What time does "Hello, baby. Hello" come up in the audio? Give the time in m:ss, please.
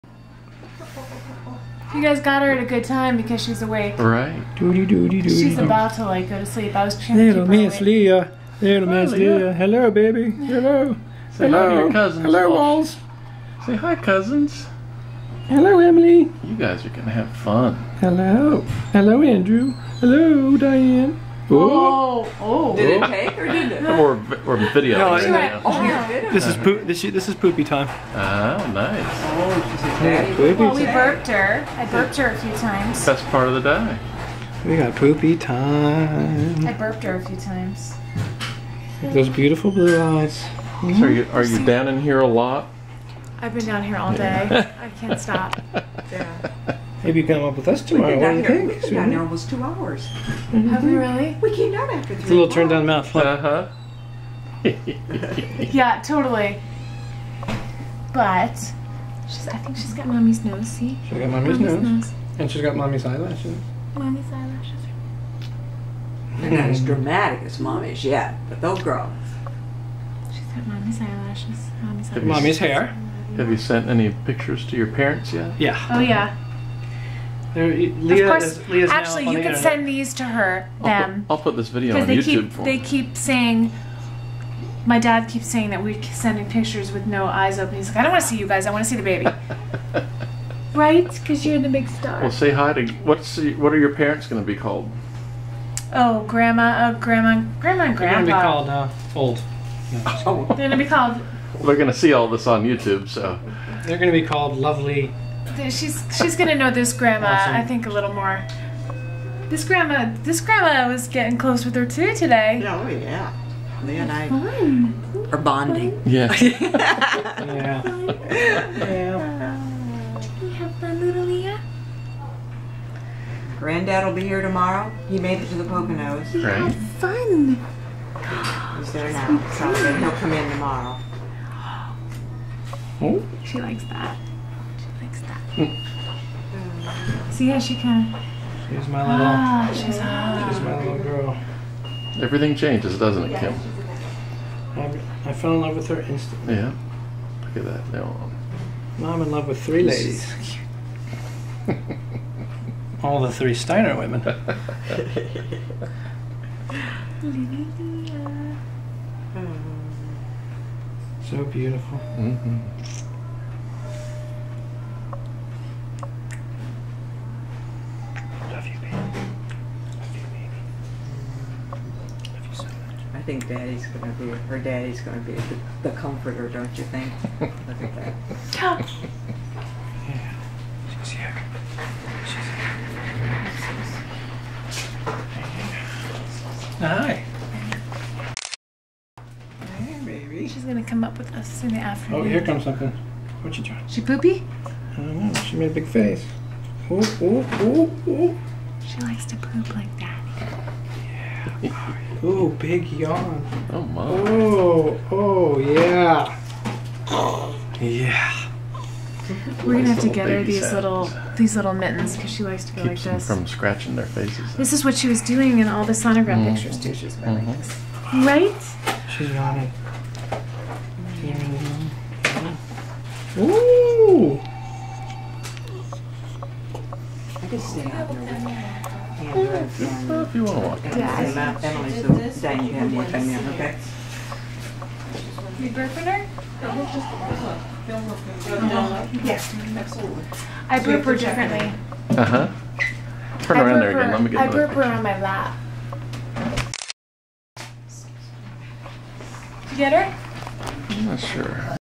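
0:09.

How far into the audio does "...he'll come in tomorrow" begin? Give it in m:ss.
2:09.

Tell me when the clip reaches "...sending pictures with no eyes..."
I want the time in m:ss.
1:26.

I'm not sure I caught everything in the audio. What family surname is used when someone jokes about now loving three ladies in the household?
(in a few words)
Steiner.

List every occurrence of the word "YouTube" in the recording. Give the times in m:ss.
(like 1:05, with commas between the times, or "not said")
1:22, 1:42.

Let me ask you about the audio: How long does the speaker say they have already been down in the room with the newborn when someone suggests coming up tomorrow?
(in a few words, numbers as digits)
almost two hours.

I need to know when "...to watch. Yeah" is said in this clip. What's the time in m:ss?
3:50.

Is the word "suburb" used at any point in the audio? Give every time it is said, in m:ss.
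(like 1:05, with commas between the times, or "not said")
not said.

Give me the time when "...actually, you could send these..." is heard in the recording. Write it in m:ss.
1:18.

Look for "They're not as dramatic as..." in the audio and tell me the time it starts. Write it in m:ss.
1:06.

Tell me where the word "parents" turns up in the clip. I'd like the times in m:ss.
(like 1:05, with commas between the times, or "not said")
1:14, 1:33.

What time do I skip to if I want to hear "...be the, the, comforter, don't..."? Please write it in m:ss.
2:55.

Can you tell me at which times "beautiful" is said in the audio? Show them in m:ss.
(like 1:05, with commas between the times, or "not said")
0:39, 2:41.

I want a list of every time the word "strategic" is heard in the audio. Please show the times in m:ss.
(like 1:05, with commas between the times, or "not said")
not said.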